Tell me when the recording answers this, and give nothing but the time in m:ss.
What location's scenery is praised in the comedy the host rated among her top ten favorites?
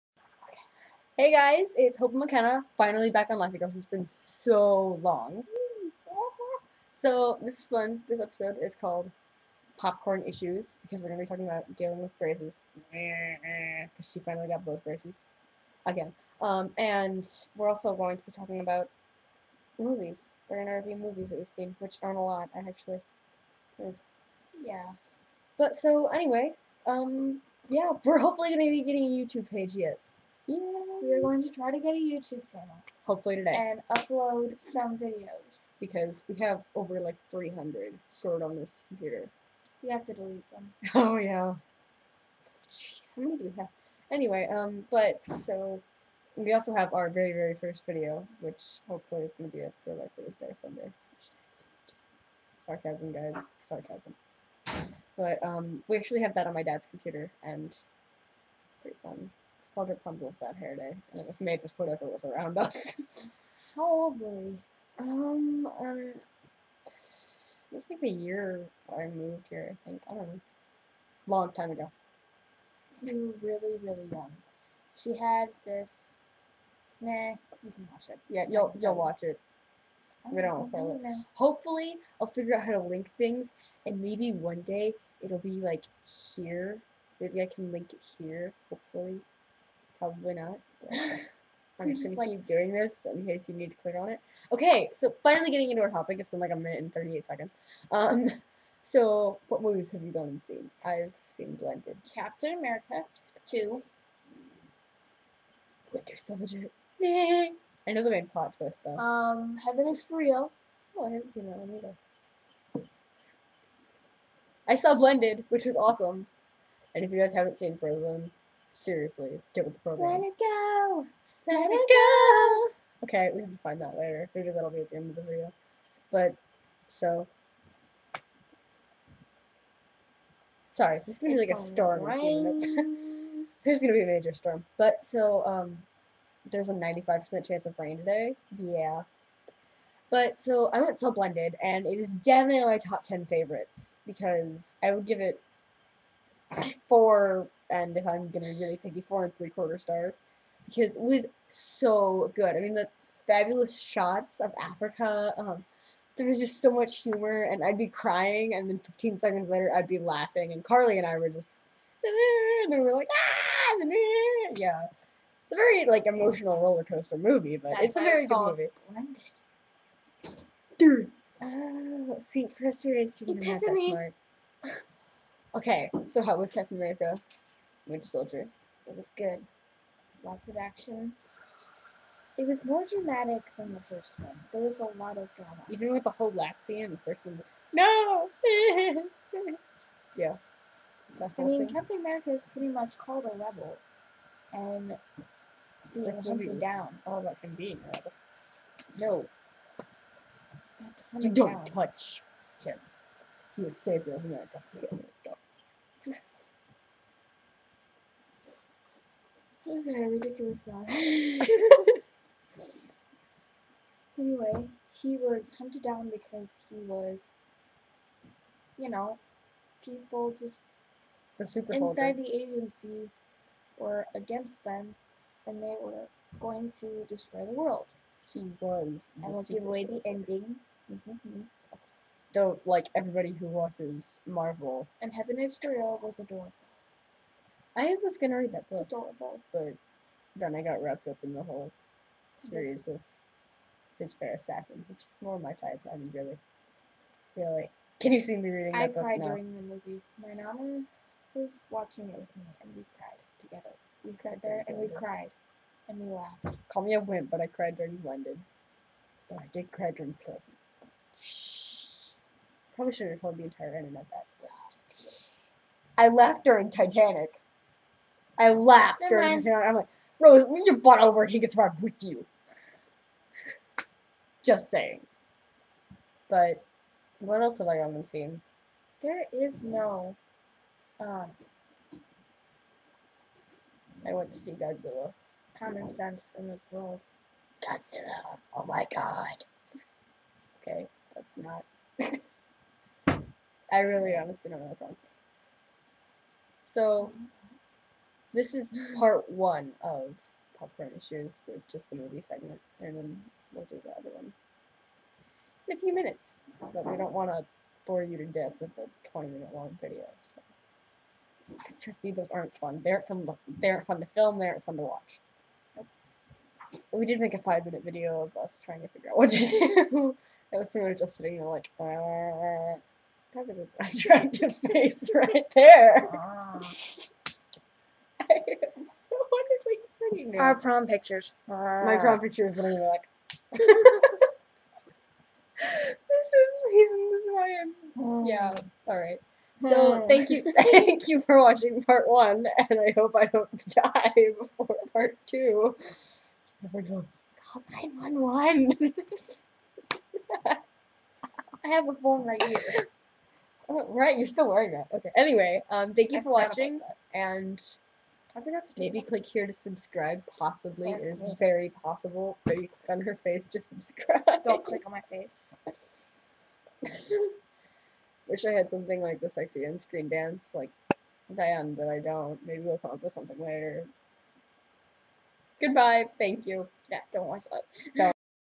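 2:34.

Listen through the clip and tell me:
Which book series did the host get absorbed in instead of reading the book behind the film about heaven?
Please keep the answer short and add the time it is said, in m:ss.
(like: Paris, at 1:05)
His Fair Assassin, at 4:03.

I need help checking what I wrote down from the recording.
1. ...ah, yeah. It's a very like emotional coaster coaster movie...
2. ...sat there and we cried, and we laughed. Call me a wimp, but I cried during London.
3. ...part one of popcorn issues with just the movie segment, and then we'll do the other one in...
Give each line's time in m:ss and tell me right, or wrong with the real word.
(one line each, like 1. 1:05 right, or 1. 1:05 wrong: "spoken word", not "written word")
1. 2:43 wrong: "roller", not "coaster"
2. 4:14 right
3. 4:58 right.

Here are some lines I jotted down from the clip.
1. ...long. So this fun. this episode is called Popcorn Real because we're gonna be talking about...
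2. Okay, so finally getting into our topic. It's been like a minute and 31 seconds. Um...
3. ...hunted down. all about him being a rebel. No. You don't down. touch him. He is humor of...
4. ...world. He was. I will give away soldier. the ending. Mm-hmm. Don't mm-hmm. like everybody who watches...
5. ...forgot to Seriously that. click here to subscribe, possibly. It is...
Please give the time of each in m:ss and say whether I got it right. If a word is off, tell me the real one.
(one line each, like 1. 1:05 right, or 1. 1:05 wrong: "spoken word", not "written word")
1. 0:05 wrong: "Issues", not "Real"
2. 1:34 wrong: "38", not "31"
3. 3:16 wrong: "savior", not "humor"
4. 3:47 right
5. 5:58 wrong: "Maybe", not "Seriously".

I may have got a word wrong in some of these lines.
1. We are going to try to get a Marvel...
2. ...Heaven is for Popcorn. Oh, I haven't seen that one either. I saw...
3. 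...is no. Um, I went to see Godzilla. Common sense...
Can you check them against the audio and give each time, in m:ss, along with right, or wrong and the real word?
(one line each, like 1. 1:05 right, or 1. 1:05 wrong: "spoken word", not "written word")
1. 0:31 wrong: "YouTube", not "Marvel"
2. 1:49 wrong: "Real", not "Popcorn"
3. 4:39 right.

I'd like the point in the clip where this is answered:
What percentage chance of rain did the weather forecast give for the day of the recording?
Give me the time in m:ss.
2:16.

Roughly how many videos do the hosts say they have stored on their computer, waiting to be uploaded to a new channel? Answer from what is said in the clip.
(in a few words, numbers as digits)
300.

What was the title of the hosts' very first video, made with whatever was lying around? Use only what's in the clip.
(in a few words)
Rapunzel's Bad Hair Day.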